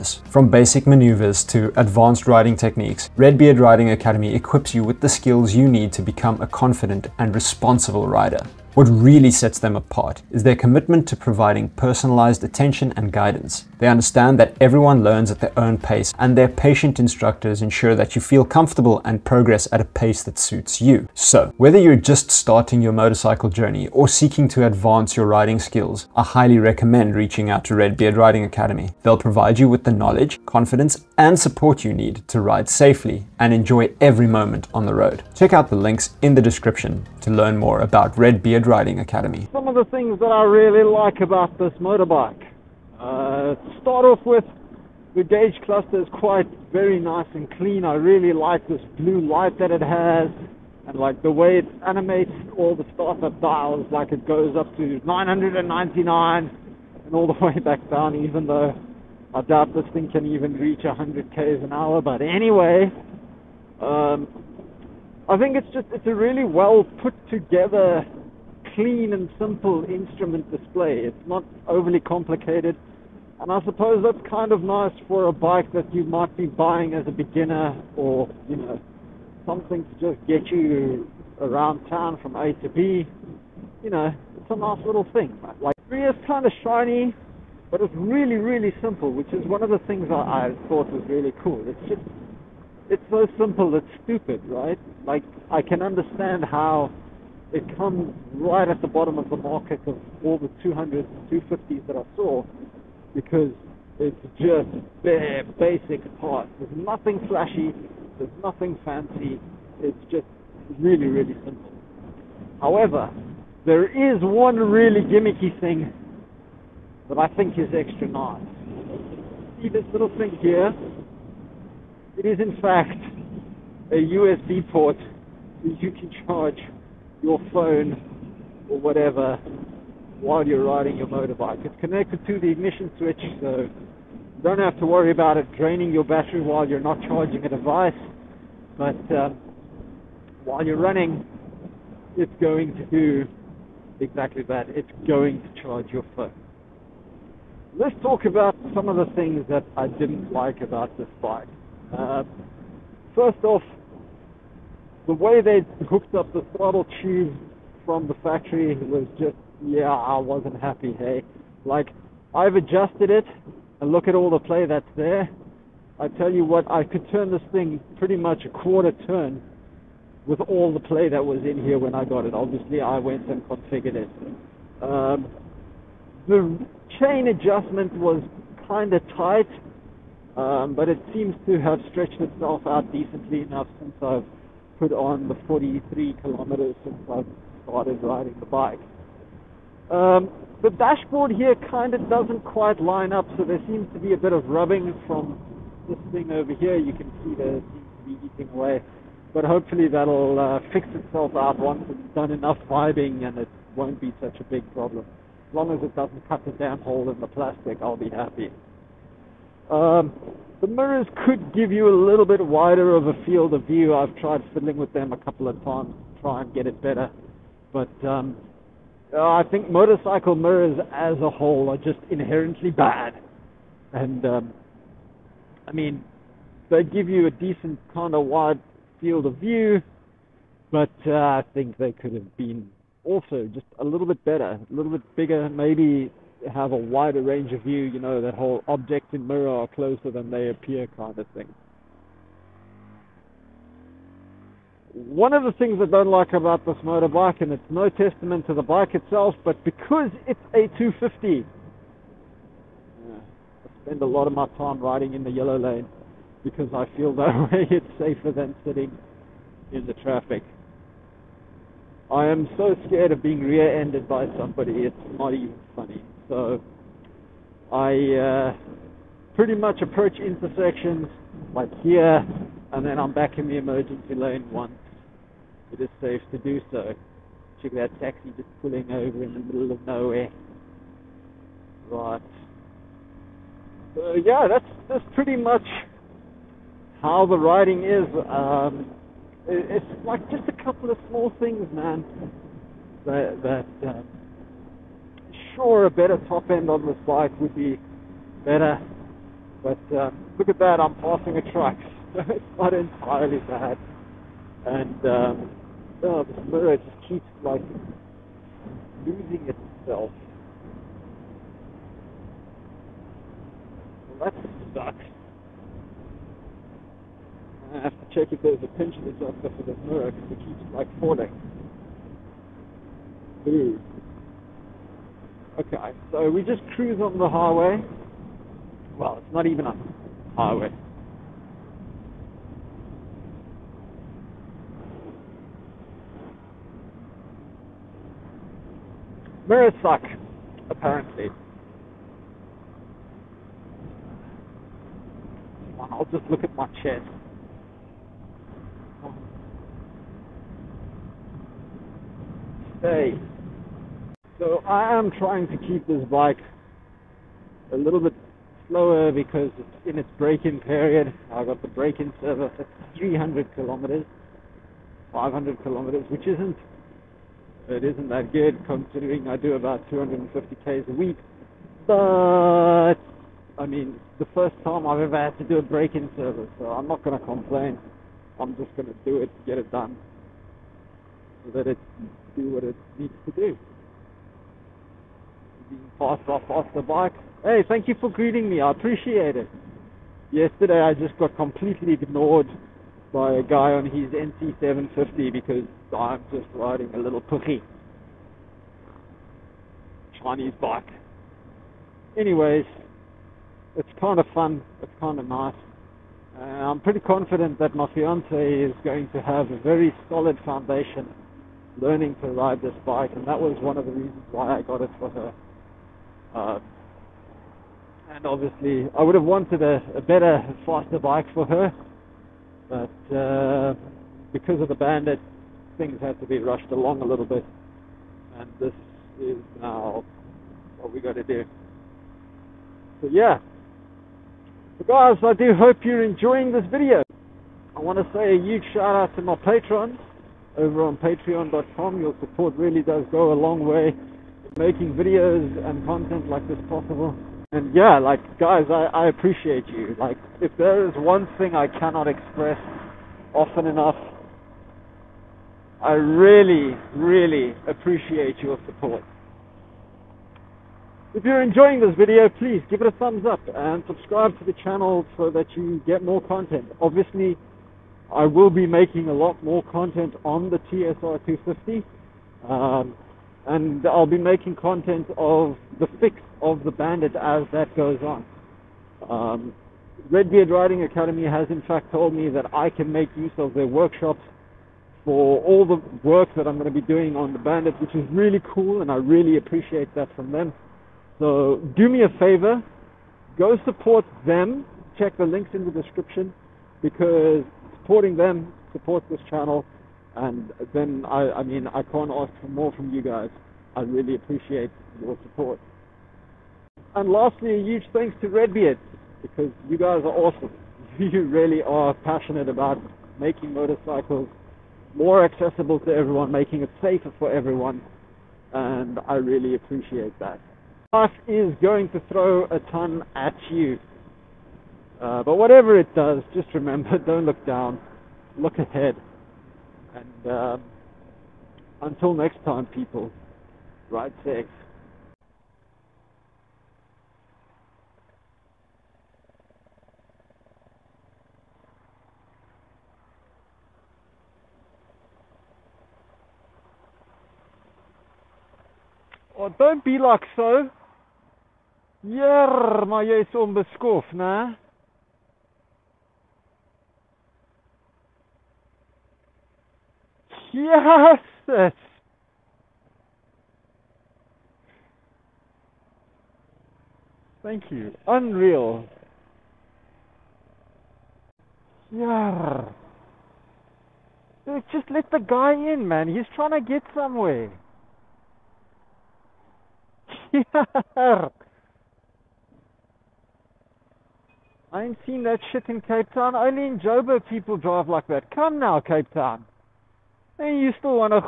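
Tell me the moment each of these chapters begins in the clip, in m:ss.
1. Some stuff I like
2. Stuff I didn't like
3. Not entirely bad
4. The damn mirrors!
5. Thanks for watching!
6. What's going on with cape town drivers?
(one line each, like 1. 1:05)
1. 0:39
2. 2:28
3. 4:57
4. 5:23
5. 7:14
6. 8:54.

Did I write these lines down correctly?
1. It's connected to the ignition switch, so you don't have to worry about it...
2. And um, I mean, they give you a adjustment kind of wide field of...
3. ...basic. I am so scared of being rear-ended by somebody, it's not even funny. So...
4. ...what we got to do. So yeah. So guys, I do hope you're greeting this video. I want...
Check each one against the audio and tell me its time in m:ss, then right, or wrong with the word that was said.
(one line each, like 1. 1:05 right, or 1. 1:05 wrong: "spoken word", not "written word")
1. 2:11 right
2. 3:43 wrong: "decent", not "adjustment"
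3. 4:19 wrong: "traffic", not "basic"
4. 7:10 wrong: "enjoying", not "greeting".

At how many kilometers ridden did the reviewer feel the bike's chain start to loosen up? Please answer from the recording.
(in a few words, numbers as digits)
43.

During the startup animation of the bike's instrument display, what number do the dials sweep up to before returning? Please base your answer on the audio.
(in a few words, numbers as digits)
999.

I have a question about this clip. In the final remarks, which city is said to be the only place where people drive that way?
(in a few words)
Joburg.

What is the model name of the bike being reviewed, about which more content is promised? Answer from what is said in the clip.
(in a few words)
TSR 250.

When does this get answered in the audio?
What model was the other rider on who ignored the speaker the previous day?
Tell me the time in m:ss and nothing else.
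6:34.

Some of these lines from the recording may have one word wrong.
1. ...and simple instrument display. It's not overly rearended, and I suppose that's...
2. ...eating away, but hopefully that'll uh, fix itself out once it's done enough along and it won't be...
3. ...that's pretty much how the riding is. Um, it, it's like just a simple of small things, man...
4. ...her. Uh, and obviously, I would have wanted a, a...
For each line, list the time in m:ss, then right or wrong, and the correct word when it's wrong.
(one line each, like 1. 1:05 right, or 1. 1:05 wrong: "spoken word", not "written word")
1. 1:09 wrong: "complicated", not "rearended"
2. 3:18 wrong: "vibing", not "along"
3. 4:44 wrong: "couple", not "simple"
4. 6:55 right.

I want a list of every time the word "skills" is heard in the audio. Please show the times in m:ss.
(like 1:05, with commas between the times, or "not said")
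0:05, 0:25.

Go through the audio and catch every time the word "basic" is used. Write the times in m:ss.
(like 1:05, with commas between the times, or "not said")
0:00, 1:45.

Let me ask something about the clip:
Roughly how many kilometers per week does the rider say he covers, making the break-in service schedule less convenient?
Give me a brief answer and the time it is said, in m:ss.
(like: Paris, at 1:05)
250, at 6:09.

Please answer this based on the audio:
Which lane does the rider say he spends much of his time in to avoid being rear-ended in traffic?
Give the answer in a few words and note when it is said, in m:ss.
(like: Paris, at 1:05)
yellow lane, at 4:15.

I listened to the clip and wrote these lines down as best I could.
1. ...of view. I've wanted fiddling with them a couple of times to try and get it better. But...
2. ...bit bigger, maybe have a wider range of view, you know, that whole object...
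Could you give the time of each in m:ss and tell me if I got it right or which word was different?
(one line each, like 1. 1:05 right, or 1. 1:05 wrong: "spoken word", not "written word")
1. 3:33 wrong: "tried", not "wanted"
2. 3:54 right.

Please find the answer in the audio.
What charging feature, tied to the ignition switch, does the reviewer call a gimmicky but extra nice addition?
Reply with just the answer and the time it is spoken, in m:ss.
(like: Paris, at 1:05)
USB port, at 2:03.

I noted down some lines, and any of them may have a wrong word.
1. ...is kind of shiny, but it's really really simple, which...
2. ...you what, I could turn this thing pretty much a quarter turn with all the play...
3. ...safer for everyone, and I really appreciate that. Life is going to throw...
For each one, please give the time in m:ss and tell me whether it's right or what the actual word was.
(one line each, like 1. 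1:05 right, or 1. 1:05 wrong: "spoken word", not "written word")
1. 1:26 right
2. 2:46 right
3. 8:36 right.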